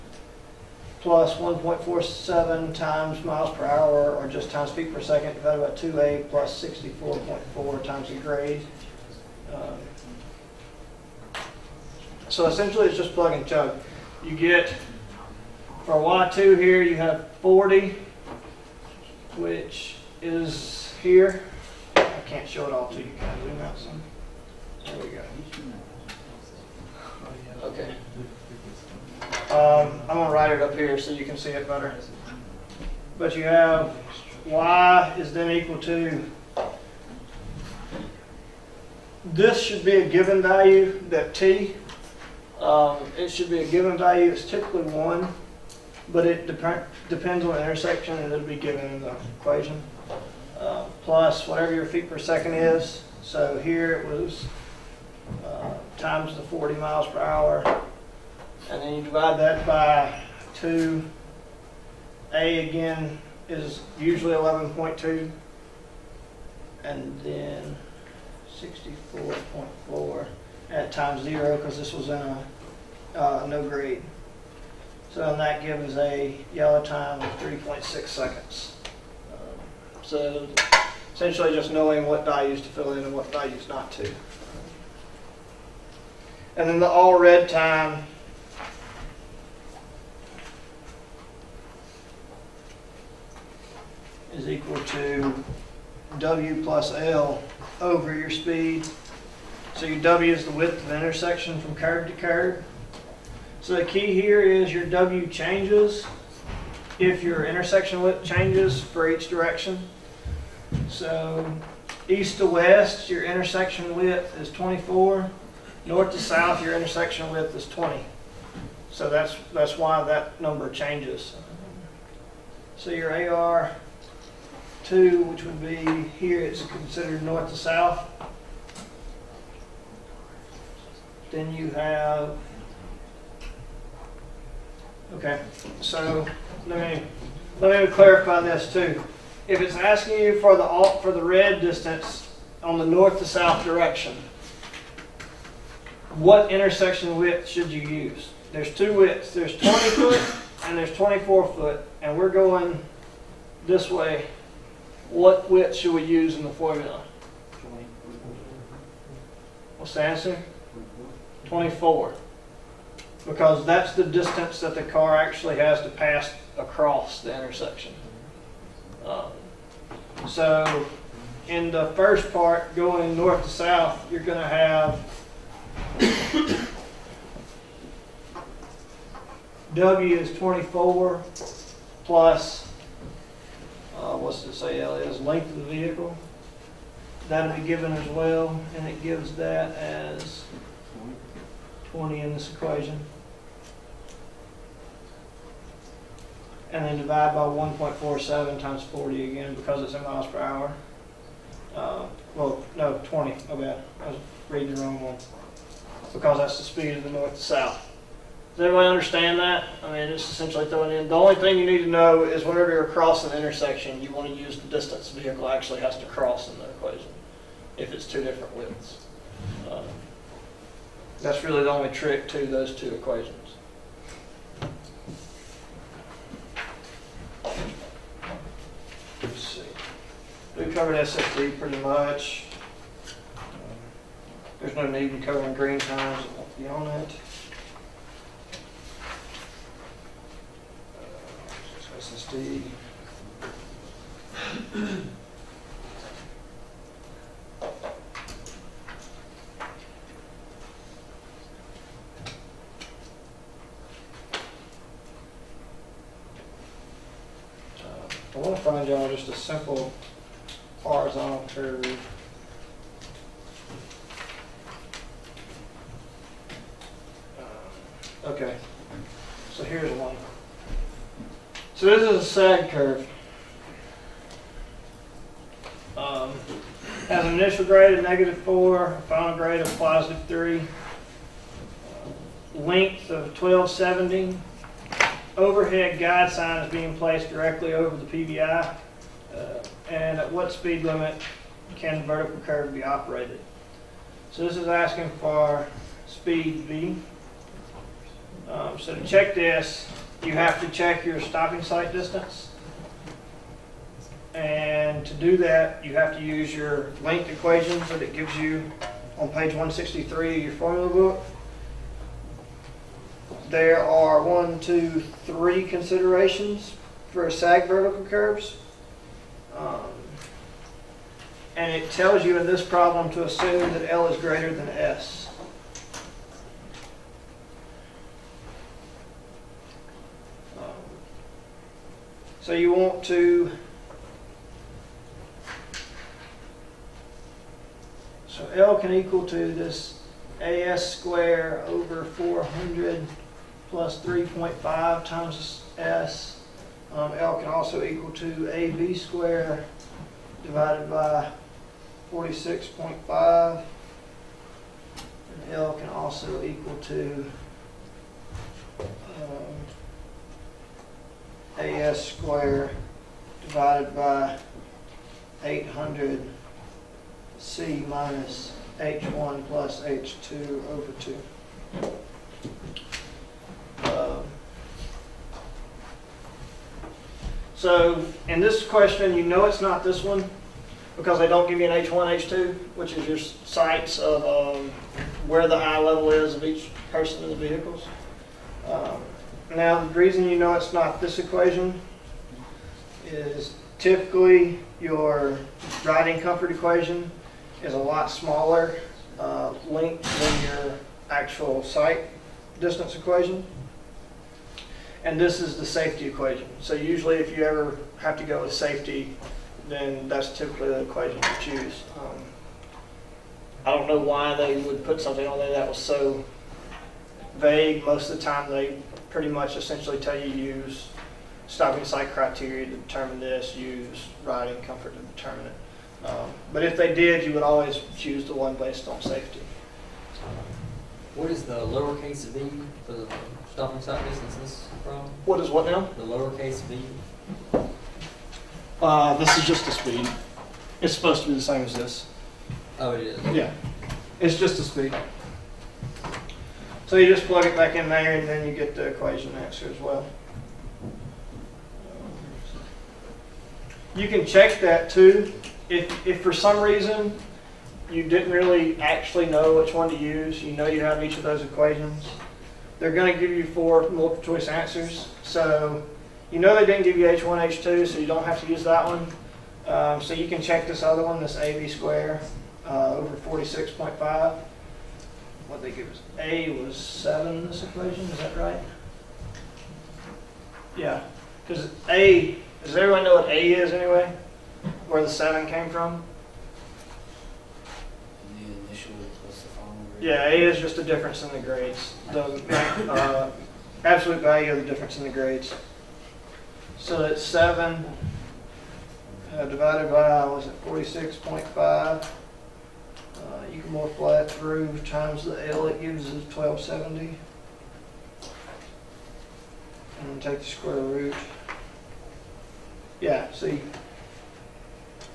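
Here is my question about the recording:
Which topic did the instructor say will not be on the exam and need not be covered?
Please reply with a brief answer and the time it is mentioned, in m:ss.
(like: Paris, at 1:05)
green times, at 3:55.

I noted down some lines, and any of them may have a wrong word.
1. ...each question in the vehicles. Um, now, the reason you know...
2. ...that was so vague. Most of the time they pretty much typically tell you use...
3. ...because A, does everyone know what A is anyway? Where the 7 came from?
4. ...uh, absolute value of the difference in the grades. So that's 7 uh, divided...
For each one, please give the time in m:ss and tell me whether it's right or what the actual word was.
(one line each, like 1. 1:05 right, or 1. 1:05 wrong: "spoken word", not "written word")
1. 6:26 wrong: "person", not "question"
2. 6:55 wrong: "essentially", not "typically"
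3. 8:01 right
4. 8:12 right.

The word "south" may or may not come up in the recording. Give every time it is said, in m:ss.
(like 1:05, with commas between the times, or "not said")
1:56, 2:07, 2:23, 2:53, 3:27.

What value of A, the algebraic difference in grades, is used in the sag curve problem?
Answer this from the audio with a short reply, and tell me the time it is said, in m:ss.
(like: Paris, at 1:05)
7, at 7:56.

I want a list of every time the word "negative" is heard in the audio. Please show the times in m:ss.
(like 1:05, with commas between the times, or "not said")
4:38.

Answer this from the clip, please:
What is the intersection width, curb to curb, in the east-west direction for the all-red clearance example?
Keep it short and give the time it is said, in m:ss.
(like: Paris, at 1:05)
24, at 1:52.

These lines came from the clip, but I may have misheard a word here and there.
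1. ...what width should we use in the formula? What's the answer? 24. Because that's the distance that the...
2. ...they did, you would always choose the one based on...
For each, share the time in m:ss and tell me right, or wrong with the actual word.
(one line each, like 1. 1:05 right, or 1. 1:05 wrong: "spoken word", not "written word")
1. 2:35 right
2. 7:06 right.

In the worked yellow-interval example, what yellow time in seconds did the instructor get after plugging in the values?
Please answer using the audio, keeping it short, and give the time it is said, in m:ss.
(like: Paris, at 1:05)
3.6 seconds, at 1:17.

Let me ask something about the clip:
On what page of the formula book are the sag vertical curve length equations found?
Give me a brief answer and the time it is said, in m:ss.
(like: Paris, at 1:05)
163, at 5:09.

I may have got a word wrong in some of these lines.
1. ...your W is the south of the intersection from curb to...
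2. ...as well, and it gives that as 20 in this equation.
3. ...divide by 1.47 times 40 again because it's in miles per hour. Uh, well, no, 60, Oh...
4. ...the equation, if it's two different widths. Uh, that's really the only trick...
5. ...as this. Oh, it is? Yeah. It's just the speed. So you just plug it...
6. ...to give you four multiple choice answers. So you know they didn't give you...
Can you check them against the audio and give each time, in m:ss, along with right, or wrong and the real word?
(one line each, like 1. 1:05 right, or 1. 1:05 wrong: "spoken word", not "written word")
1. 1:39 wrong: "width", not "south"
2. 3:07 right
3. 3:16 wrong: "20", not "60"
4. 3:36 right
5. 7:21 right
6. 7:43 right.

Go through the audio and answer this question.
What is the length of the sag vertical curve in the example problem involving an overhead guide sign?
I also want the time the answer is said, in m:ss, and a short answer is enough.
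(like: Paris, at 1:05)
1270, at 4:42.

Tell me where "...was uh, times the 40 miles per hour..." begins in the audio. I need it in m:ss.
0:54.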